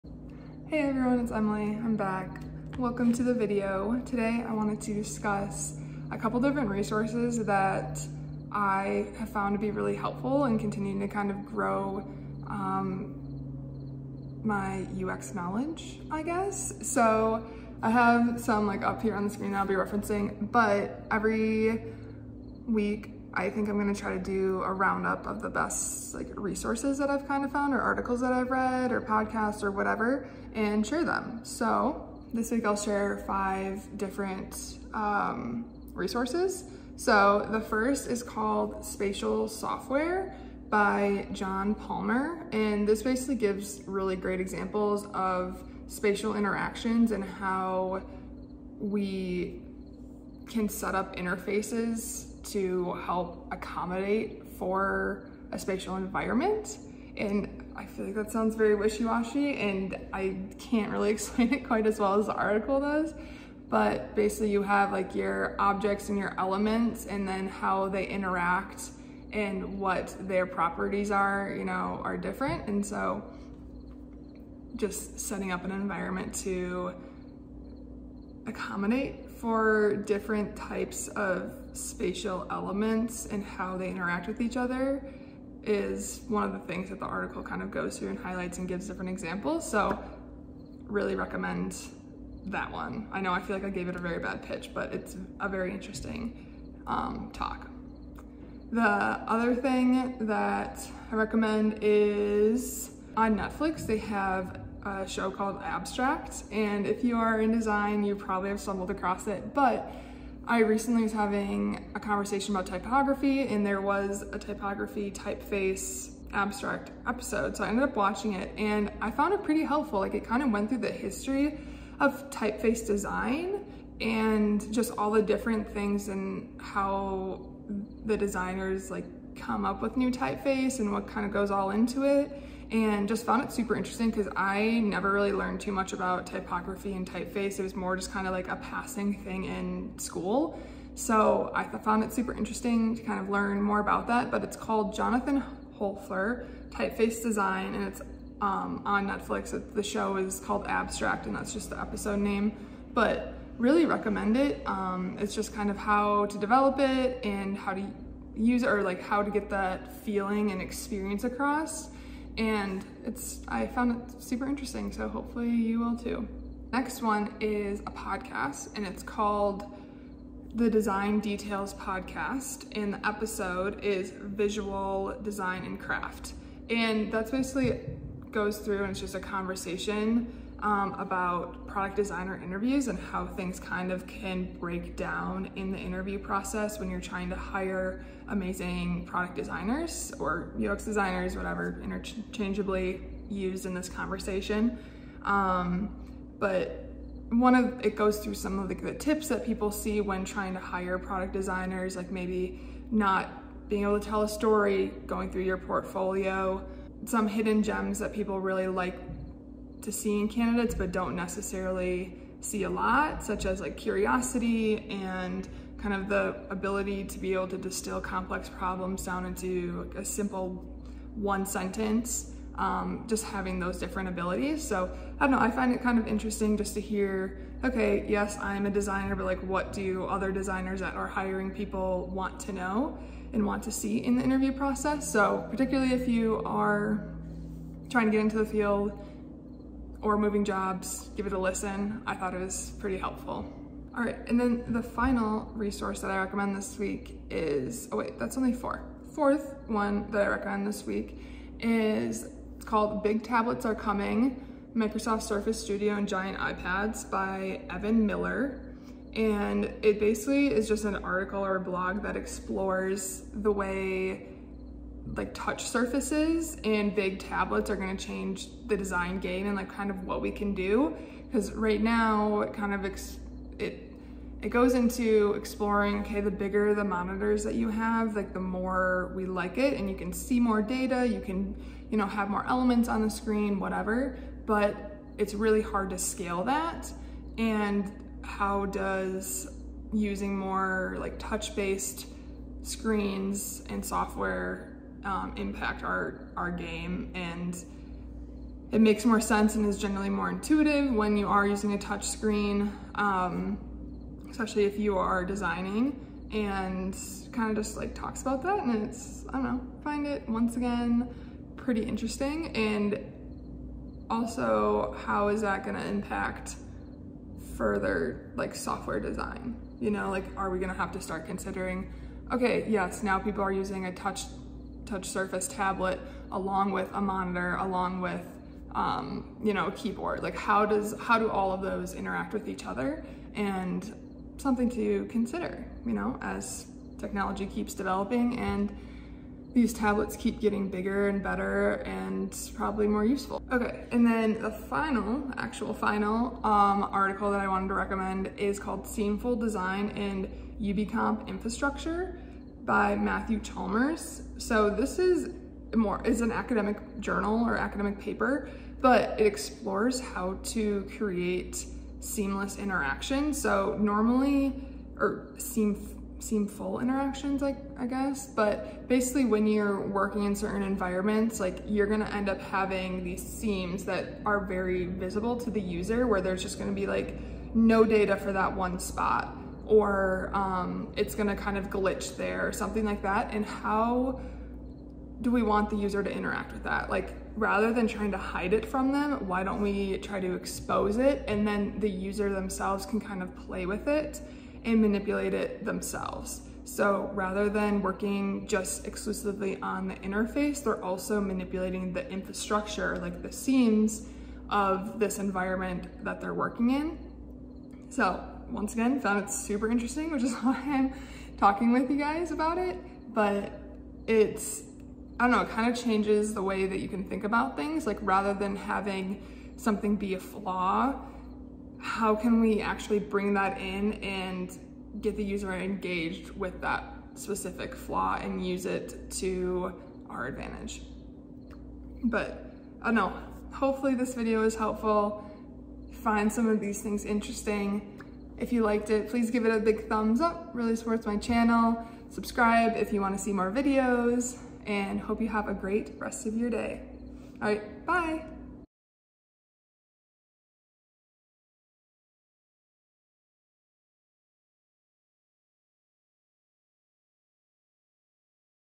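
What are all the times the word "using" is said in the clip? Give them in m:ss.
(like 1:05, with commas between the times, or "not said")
4:49, 5:01, 5:23.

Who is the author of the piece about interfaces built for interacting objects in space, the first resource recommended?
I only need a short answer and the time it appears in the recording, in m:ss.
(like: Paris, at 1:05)
John Palmer, at 0:41.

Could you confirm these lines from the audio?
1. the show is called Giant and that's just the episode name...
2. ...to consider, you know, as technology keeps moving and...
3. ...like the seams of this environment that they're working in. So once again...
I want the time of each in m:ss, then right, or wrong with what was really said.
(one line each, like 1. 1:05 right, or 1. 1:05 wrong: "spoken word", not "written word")
1. 2:29 wrong: "Abstract", not "Giant"
2. 5:34 wrong: "developing", not "moving"
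3. 6:42 right.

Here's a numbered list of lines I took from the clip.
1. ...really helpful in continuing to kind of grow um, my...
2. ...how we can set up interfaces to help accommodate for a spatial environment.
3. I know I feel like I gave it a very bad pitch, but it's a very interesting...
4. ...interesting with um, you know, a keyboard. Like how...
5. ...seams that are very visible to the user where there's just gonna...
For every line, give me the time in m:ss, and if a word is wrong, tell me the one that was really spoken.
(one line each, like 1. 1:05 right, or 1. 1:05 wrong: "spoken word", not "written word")
1. 0:09 right
2. 0:47 right
3. 1:33 right
4. 5:27 wrong: "along", not "interesting"
5. 6:13 right.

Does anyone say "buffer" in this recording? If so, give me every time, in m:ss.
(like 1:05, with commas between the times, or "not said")
not said.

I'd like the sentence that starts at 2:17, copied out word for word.
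It was more just kind of like a passing thing in school.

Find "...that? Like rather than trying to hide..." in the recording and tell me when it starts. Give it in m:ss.
6:26.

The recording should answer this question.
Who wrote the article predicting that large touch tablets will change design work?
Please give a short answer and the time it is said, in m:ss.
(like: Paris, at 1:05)
Evan Miller, at 4:17.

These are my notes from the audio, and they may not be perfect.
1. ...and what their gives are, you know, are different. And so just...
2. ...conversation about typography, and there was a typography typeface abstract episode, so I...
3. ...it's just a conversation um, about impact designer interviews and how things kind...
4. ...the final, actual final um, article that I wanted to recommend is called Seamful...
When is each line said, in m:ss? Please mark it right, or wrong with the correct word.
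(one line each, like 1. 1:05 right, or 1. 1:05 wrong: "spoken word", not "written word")
1. 1:09 wrong: "properties", not "gives"
2. 1:51 right
3. 2:58 wrong: "product", not "impact"
4. 5:44 right.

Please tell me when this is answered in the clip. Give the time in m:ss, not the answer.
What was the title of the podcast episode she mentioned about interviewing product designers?
2:54.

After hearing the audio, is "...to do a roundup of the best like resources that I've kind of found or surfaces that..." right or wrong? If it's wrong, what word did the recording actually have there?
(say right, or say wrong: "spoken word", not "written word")
wrong: "articles", not "surfaces".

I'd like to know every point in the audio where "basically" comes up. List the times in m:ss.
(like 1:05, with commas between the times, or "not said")
0:43, 1:04, 2:57, 4:19, 6:08.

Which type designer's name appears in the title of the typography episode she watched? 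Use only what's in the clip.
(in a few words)
Jonathan Hoefler.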